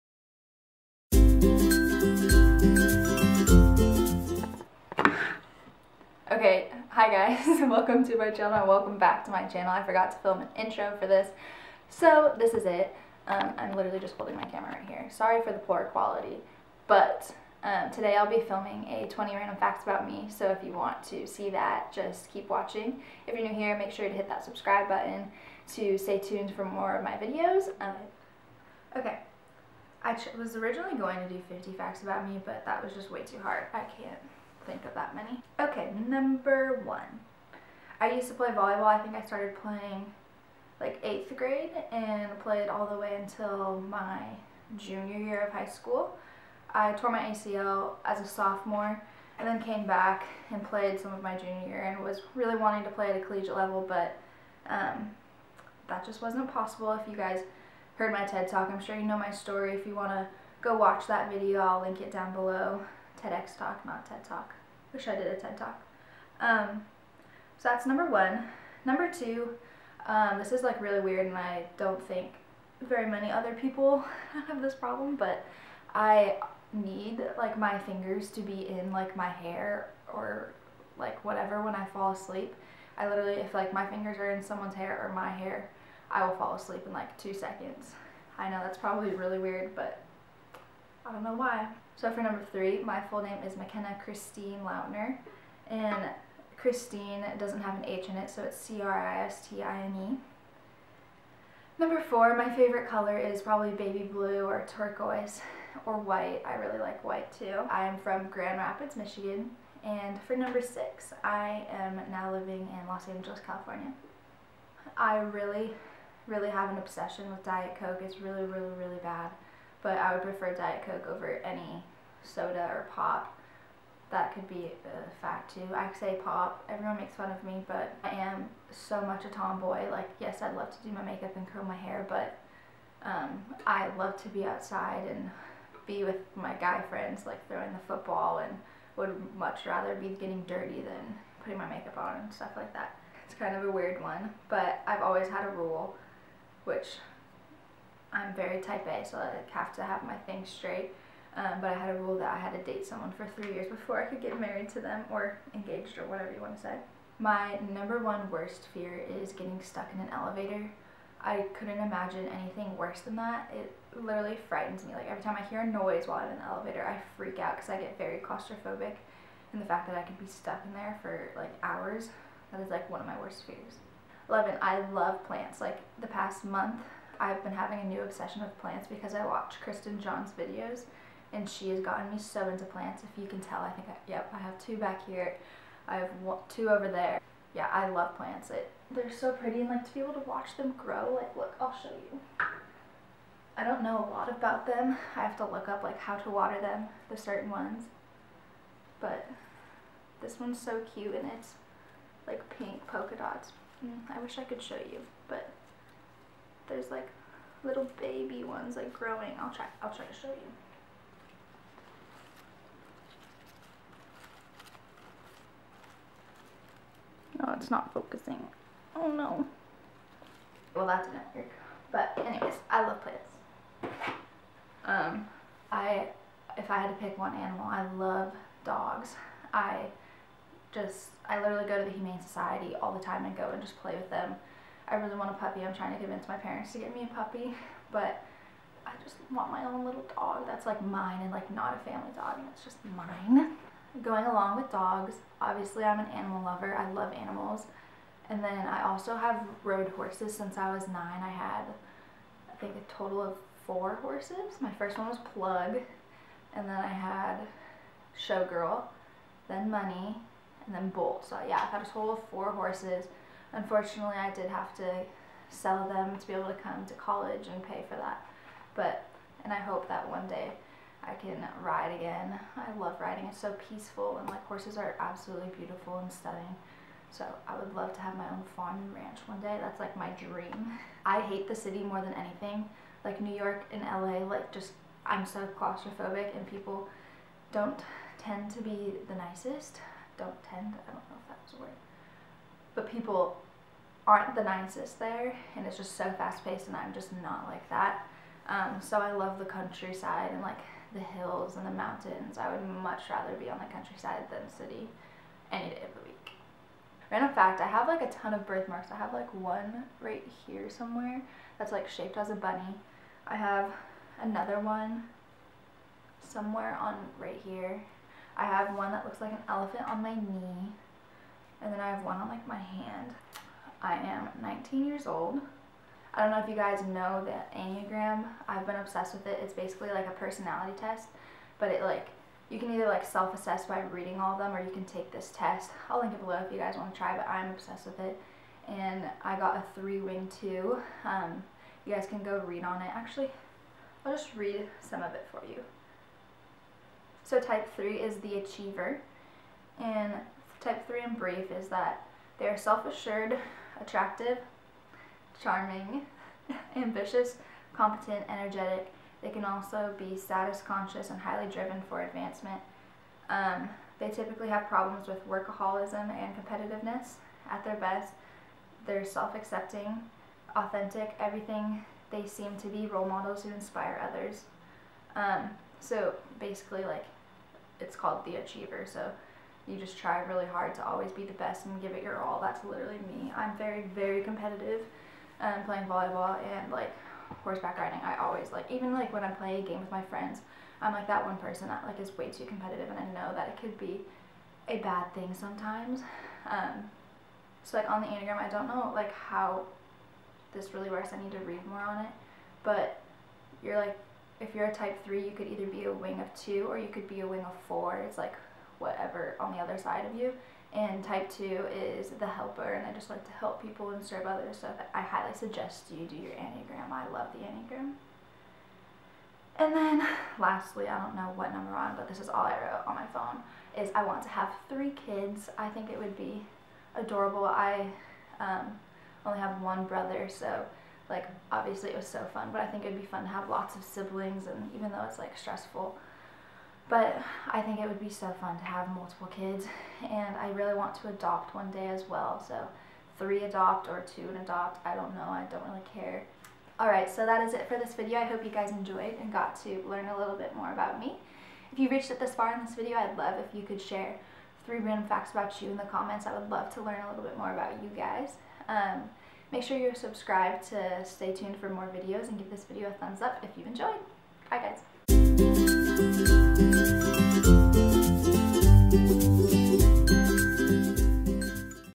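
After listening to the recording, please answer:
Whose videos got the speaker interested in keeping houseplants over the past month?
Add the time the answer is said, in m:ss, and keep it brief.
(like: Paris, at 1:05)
Kristen John, at 2:59.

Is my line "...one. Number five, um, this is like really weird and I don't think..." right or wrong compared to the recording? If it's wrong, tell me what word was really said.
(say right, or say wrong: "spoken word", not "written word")
wrong: "two", not "five".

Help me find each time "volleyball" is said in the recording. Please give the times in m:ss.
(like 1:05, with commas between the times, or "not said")
0:38, 6:25.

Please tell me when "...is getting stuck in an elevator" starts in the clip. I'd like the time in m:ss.
2:39.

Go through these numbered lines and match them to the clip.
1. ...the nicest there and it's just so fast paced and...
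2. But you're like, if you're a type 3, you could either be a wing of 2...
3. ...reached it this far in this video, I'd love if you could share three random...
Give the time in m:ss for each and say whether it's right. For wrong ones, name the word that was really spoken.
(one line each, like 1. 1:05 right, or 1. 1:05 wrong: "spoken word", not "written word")
1. 4:54 right
2. 6:42 right
3. 7:31 right.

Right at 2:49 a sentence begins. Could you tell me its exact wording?
And the fact that I could be stuck in there for like hours, that is like one of my worst fears.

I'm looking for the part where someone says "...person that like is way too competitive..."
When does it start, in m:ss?
6:31.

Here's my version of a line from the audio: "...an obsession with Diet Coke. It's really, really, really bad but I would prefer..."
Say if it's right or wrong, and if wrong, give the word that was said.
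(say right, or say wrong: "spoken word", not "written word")
right.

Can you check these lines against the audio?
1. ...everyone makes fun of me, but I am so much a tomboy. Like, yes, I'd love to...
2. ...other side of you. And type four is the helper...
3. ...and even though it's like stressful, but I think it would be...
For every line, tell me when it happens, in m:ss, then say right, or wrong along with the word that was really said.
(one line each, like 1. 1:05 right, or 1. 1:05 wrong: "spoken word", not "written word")
1. 2:06 right
2. 6:49 wrong: "two", not "four"
3. 7:14 right.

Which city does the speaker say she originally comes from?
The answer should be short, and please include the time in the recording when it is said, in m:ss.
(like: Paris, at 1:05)
Grand Rapids, Michigan, at 1:48.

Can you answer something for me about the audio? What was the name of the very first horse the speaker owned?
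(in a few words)
Plug.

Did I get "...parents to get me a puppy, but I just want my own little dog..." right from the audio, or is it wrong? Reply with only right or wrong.
right.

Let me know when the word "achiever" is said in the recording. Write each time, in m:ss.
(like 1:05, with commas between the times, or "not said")
5:48, 6:18.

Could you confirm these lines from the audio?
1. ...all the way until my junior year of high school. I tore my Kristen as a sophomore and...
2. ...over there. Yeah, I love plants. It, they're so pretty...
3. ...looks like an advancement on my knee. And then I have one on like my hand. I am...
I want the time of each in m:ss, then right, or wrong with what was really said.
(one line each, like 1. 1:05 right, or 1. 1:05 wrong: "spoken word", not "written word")
1. 0:42 wrong: "ACL", not "Kristen"
2. 3:06 right
3. 5:19 wrong: "elephant", not "advancement".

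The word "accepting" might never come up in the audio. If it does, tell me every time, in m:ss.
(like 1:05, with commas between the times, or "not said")
6:09.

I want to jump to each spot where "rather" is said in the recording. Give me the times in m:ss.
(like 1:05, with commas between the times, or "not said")
2:19, 5:03.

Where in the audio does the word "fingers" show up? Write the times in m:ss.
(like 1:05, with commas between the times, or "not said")
1:17, 1:23.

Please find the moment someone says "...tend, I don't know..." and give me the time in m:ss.
4:50.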